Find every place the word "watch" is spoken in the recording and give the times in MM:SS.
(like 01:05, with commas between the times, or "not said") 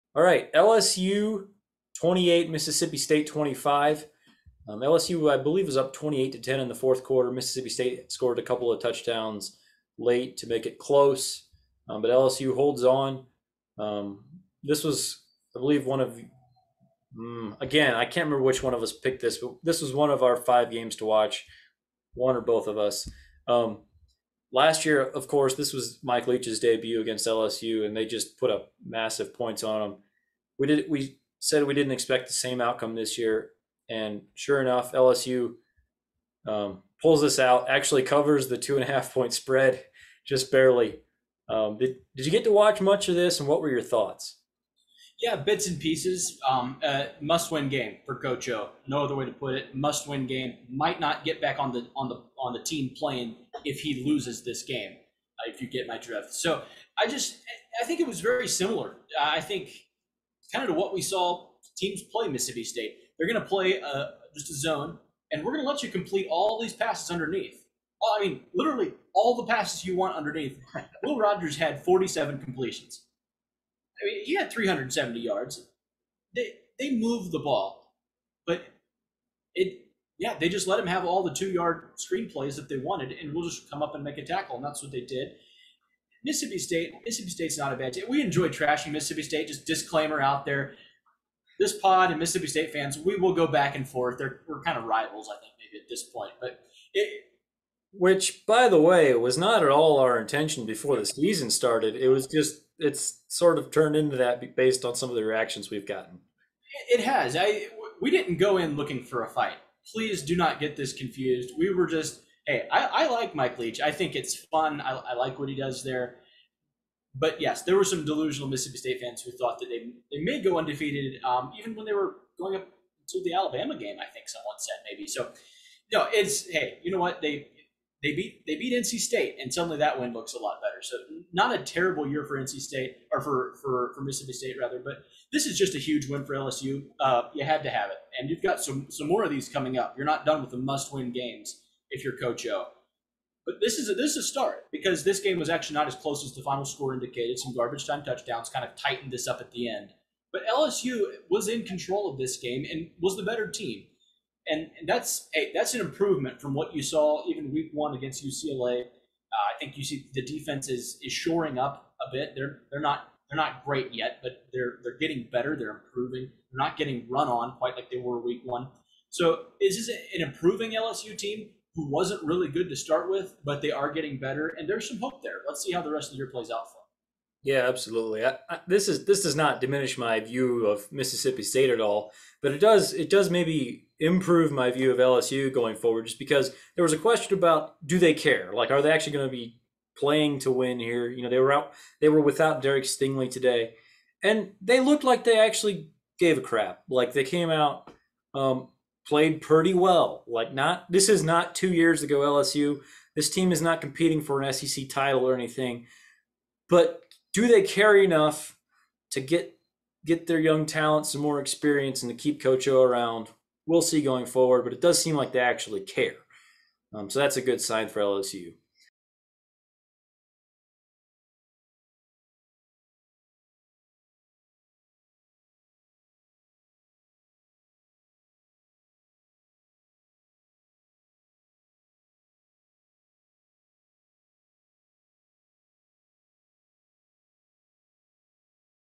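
00:21, 00:42.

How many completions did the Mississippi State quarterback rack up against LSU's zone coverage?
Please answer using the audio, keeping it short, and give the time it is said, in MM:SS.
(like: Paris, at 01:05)
47, at 01:11.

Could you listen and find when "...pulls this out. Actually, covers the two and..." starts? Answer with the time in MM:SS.
00:37.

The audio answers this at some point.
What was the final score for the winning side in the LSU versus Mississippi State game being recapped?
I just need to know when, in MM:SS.
00:00.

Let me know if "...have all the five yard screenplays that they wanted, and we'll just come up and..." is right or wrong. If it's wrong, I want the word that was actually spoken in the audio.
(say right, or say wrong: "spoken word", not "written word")
wrong: "two", not "five".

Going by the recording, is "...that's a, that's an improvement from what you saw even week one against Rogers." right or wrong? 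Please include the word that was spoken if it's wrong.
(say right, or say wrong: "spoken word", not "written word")
wrong: "UCLA", not "Rogers".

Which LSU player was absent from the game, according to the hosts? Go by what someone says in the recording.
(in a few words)
Derek Stingley.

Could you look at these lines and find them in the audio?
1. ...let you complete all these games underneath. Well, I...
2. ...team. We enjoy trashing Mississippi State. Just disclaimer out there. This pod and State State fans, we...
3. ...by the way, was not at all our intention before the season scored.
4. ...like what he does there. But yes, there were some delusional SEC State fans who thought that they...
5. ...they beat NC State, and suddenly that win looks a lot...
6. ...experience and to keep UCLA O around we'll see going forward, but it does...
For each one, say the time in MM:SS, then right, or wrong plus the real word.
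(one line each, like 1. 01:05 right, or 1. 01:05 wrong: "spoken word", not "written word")
1. 01:05 wrong: "passes", not "games"
2. 01:27 wrong: "Mississippi", not "State"
3. 01:38 wrong: "started", not "scored"
4. 01:55 wrong: "Mississippi", not "SEC"
5. 02:08 right
6. 03:31 wrong: "Coach", not "UCLA".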